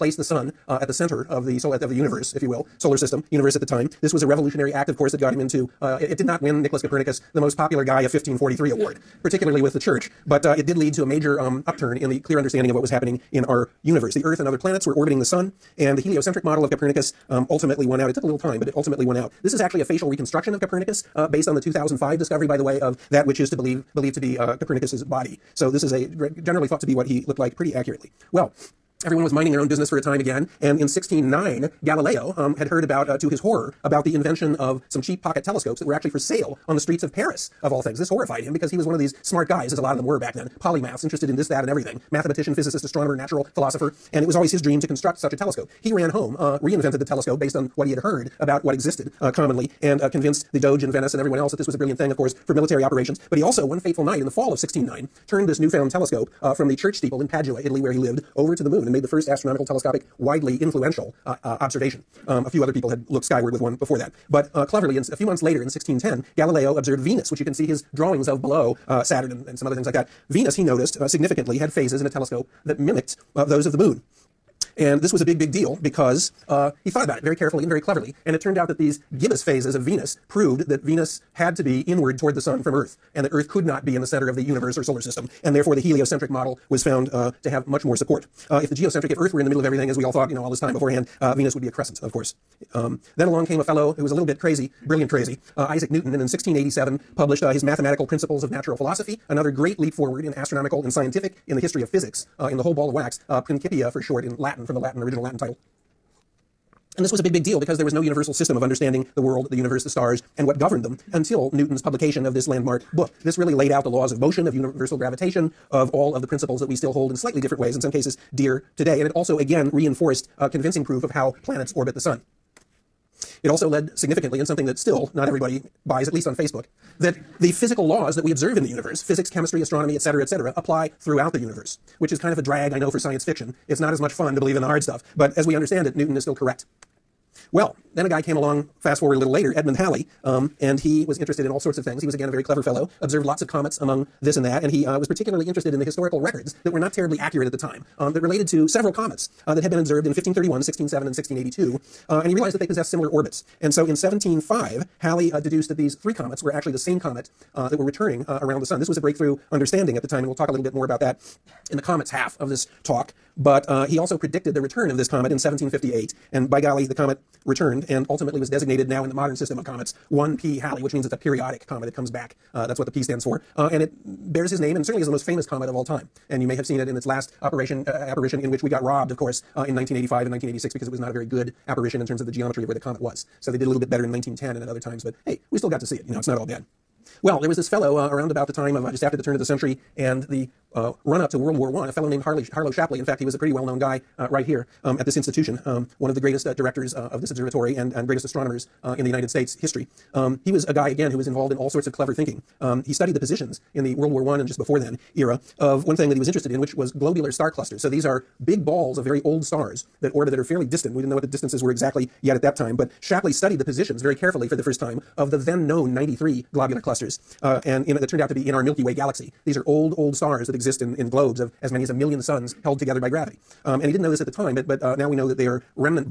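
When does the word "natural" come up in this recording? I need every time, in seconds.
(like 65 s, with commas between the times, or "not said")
43 s, 98 s.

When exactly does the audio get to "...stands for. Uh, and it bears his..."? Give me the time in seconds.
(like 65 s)
173 s.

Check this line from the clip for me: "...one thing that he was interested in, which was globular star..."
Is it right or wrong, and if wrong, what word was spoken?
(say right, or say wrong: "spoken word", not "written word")
right.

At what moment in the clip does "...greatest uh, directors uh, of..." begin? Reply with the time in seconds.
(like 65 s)
196 s.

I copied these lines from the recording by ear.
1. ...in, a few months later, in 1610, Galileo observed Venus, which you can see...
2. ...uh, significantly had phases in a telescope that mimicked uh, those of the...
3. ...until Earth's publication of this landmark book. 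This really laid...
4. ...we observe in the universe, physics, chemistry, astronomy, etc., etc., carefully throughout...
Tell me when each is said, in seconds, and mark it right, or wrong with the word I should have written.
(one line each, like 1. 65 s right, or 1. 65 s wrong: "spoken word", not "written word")
1. 64 s right
2. 70 s right
3. 111 s wrong: "Newton", not "Earth"
4. 128 s wrong: "apply", not "carefully".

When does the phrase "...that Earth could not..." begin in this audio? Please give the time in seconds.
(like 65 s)
83 s.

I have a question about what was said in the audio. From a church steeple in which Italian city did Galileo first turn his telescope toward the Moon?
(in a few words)
Padua.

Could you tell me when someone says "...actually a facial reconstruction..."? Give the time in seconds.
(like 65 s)
19 s.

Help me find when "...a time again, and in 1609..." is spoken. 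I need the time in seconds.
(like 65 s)
29 s.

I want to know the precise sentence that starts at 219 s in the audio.
These are old, old stars that exist in, in globes of as many as a million suns held together by gravity.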